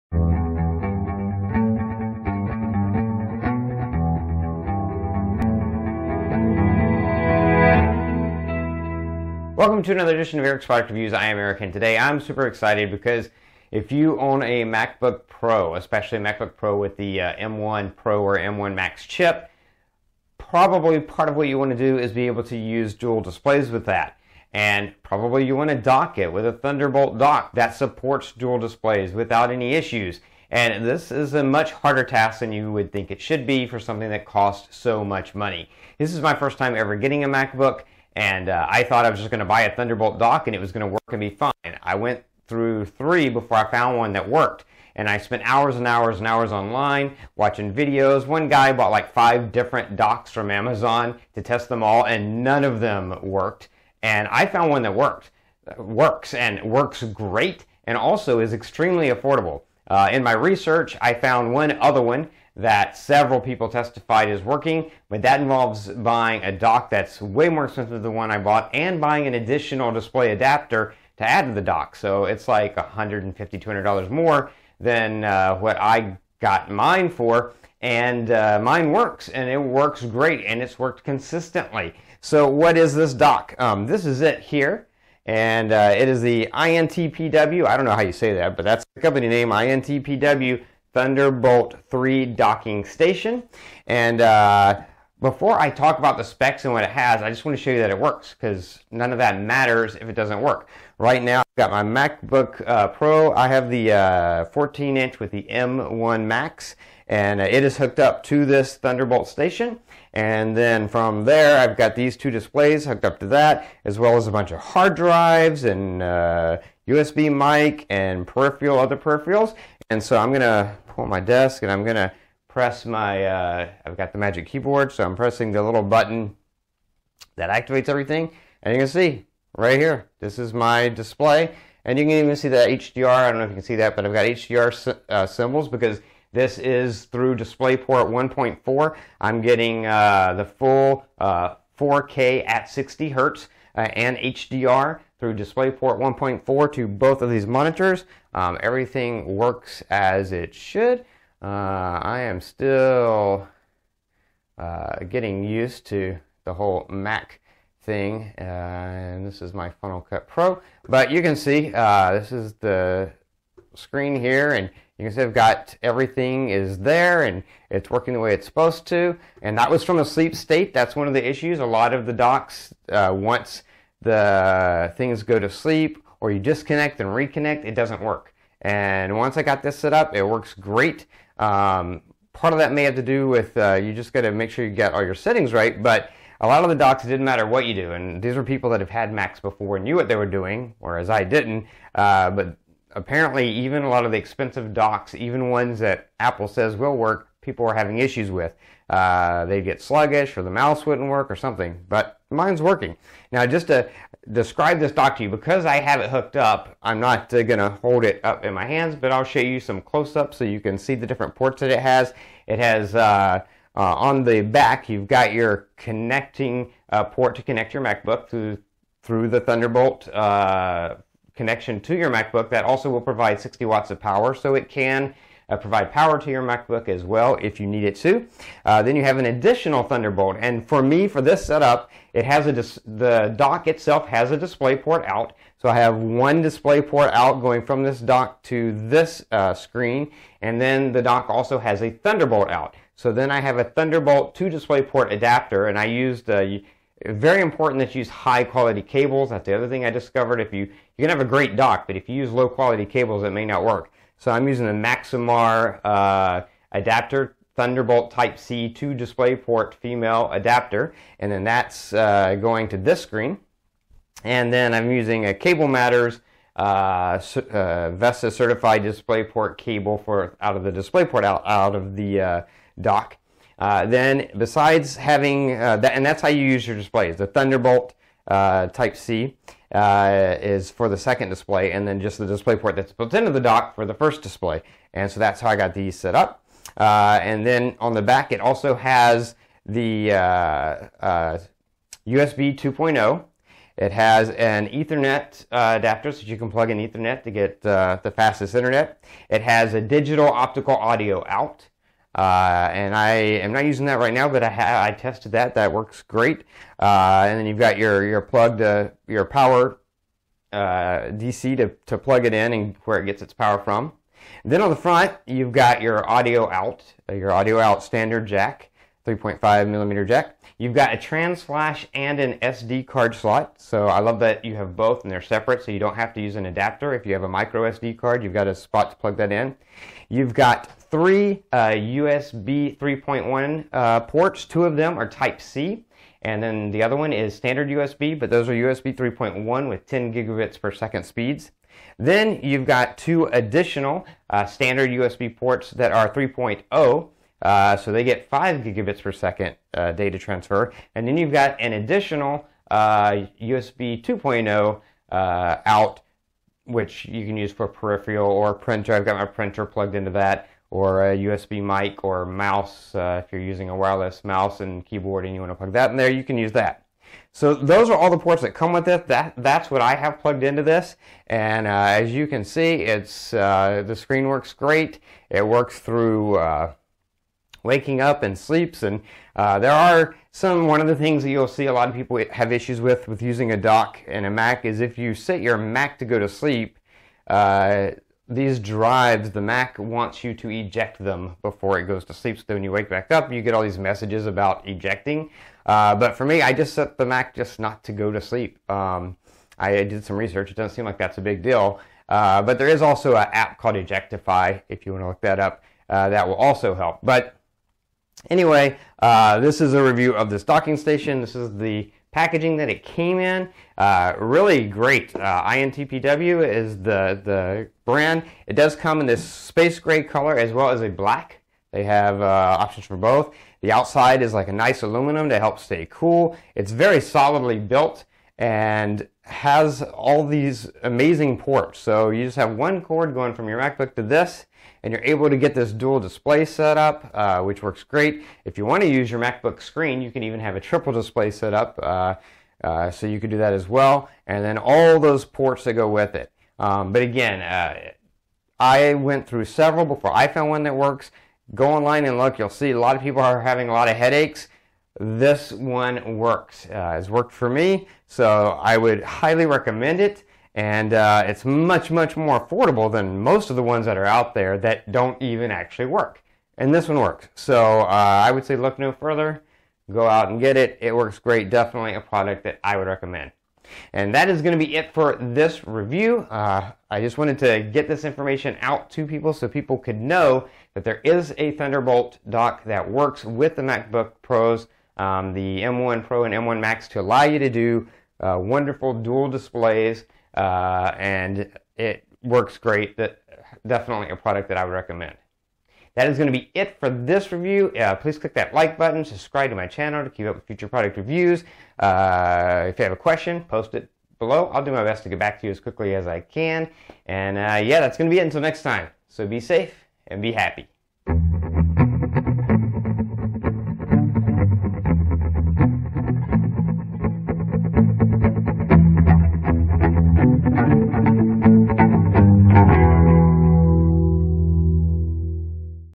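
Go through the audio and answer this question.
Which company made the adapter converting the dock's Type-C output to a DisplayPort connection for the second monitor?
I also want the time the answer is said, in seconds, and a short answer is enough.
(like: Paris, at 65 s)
Maxomar, at 254 s.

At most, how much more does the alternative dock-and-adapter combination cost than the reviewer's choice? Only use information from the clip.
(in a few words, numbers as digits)
$200.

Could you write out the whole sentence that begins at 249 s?
That's the other thing I discovered.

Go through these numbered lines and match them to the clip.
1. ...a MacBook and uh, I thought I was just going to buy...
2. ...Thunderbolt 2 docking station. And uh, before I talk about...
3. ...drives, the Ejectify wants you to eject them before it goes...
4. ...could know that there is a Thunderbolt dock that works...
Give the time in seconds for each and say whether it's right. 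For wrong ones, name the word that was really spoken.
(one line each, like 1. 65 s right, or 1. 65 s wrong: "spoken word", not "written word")
1. 37 s right
2. 90 s wrong: "3", not "2"
3. 388 s wrong: "Mac", not "Ejectify"
4. 479 s right.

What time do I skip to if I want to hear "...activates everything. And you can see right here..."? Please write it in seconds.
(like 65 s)
127 s.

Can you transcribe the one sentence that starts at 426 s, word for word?
It's very solidly built and has all these amazing ports.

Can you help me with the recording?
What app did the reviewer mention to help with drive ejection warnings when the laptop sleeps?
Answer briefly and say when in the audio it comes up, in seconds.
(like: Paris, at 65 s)
Ejectify, at 403 s.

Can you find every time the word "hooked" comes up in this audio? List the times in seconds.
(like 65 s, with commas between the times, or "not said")
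107 s, 112 s, 206 s.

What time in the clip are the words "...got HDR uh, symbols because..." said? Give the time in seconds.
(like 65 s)
134 s.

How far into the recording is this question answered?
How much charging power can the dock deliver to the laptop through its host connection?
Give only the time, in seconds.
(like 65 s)
223 s.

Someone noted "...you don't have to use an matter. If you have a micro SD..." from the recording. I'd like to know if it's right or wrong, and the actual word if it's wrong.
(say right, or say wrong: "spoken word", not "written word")
wrong: "adapter", not "matter".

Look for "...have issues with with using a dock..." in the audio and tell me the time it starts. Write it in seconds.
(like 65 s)
382 s.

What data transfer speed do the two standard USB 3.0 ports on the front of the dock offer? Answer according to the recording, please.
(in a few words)
5 gigabits per second.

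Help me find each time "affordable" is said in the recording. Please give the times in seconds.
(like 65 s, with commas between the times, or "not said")
59 s, 462 s.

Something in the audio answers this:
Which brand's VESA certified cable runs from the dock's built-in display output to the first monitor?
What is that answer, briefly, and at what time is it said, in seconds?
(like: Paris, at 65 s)
Cable Matters, at 265 s.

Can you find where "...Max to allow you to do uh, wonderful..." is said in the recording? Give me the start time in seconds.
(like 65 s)
486 s.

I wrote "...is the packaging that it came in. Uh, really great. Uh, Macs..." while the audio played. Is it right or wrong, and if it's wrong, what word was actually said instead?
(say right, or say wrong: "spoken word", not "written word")
wrong: "INTPW", not "Macs".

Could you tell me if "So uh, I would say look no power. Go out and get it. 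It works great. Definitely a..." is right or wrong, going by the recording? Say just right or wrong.
wrong.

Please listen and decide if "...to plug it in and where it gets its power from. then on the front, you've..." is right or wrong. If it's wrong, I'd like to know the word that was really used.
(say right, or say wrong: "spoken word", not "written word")
right.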